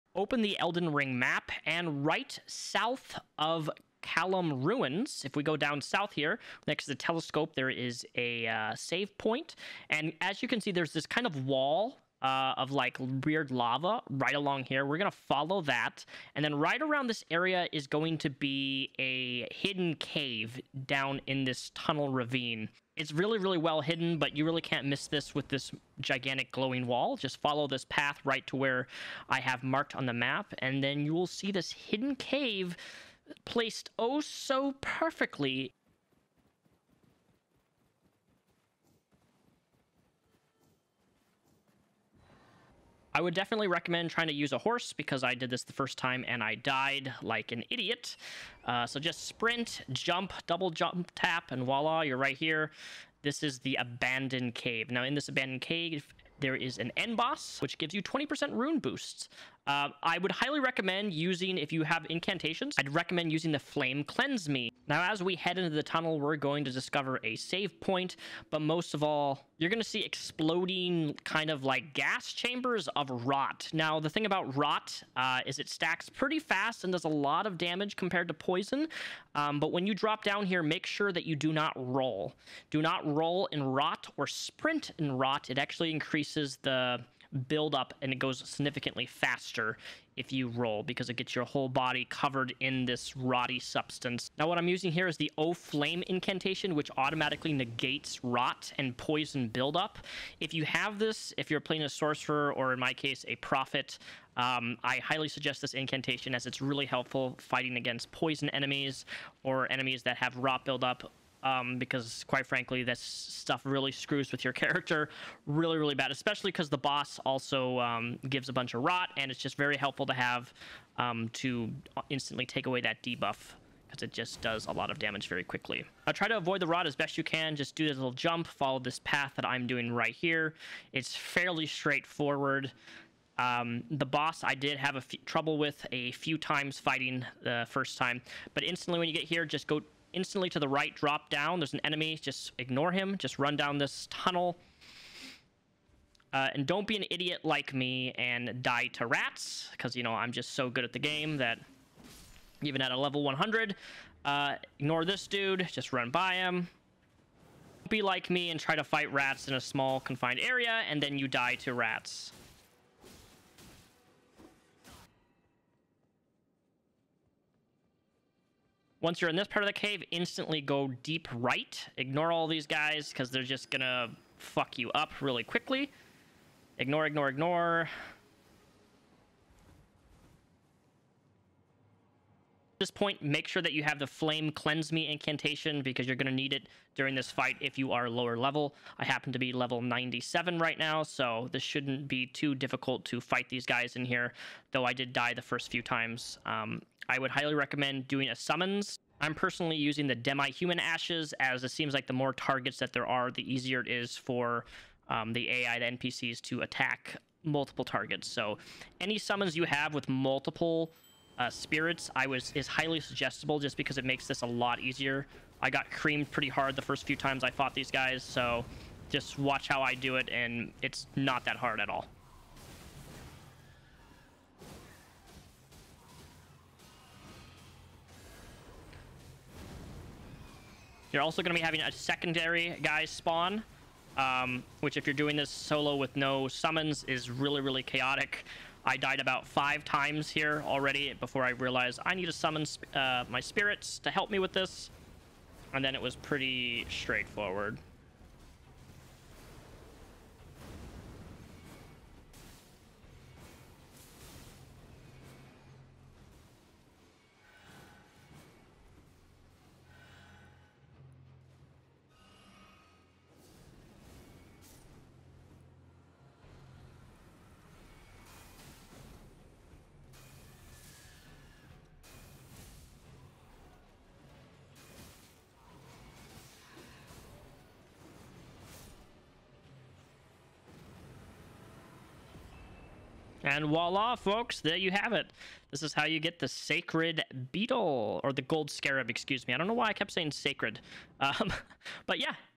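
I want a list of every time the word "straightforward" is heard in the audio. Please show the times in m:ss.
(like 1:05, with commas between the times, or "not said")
2:11, 4:06.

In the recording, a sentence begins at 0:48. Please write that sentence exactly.
Uh, so just sprint, jump, double jump, tap, and voila, you're right here.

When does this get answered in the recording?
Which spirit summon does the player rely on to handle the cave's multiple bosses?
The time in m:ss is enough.
3:20.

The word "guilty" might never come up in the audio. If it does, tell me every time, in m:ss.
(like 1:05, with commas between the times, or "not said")
not said.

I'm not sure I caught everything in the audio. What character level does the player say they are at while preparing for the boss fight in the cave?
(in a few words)
97.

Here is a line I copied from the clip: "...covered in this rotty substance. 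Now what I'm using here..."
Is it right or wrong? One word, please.
right.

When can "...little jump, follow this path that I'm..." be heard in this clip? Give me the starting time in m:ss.
2:07.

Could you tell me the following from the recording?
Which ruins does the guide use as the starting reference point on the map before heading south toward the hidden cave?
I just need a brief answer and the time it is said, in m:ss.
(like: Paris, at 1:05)
Caelem Ruins, at 0:04.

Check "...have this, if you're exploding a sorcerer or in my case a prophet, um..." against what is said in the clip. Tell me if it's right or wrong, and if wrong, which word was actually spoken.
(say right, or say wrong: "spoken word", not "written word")
wrong: "playing", not "exploding".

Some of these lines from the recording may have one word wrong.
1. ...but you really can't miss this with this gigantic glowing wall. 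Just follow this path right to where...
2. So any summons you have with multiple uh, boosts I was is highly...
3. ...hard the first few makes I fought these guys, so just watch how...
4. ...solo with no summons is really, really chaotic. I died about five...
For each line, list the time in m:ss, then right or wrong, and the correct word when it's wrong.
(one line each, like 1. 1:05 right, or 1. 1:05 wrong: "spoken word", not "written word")
1. 0:24 right
2. 3:28 wrong: "spirits", not "boosts"
3. 3:36 wrong: "times", not "makes"
4. 3:55 right.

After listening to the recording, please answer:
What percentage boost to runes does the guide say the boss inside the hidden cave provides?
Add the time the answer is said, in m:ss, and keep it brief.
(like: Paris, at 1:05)
20%, at 0:58.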